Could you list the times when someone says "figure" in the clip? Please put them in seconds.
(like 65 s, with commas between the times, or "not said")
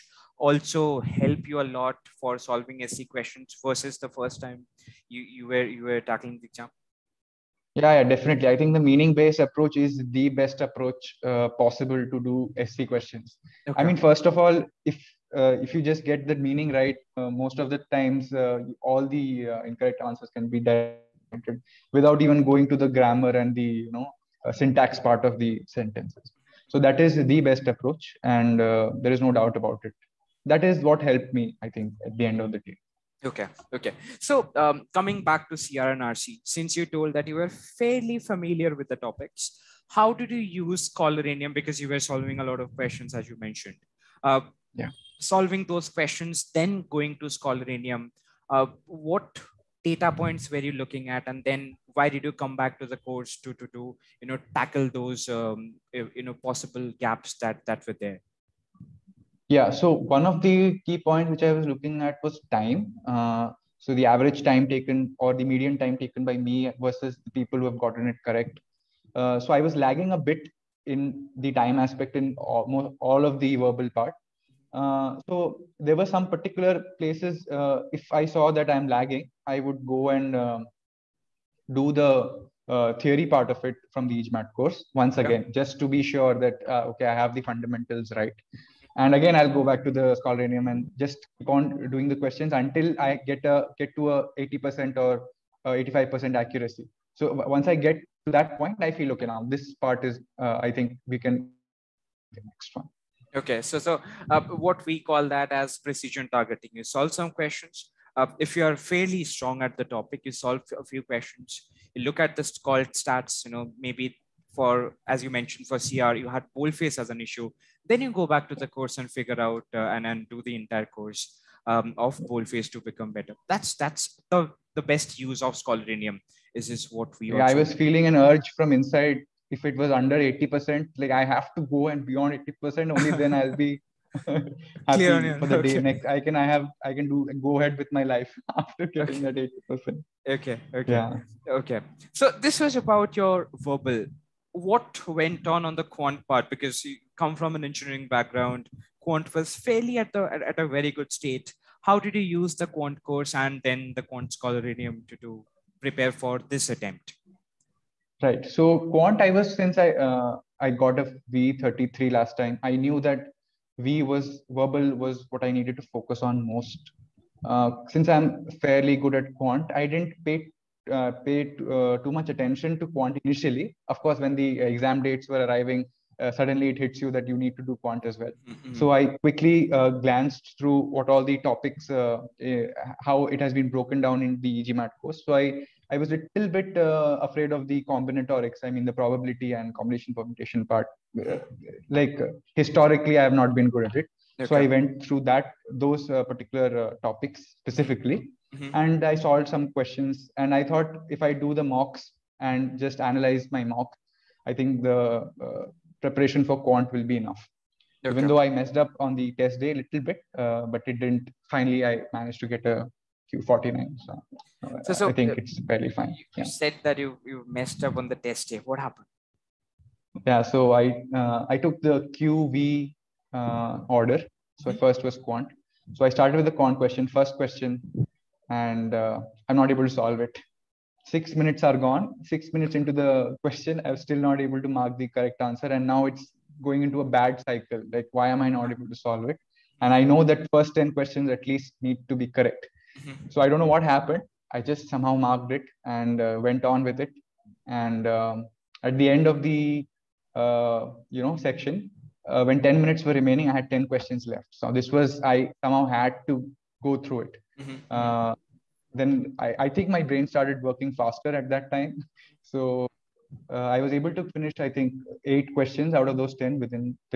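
119 s.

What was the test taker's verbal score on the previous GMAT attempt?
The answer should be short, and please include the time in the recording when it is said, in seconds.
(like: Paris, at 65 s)
V33, at 161 s.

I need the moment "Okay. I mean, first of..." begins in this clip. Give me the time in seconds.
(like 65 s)
13 s.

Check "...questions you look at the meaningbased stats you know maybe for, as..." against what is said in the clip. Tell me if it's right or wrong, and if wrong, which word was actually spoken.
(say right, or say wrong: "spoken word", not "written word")
wrong: "called", not "meaningbased".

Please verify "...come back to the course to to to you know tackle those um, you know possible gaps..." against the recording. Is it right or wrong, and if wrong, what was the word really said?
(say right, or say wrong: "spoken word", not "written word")
right.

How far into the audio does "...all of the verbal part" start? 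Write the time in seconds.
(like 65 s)
72 s.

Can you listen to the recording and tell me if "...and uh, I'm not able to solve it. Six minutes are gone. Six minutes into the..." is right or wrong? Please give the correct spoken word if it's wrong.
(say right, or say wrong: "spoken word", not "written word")
right.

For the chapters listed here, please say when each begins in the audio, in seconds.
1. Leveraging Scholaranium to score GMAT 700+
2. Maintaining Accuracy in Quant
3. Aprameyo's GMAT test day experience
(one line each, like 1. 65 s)
1. 42 s
2. 172 s
3. 218 s.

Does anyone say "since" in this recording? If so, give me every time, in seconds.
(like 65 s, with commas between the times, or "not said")
36 s, 159 s, 167 s.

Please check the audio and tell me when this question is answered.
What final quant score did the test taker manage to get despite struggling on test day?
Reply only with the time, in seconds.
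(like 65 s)
213 s.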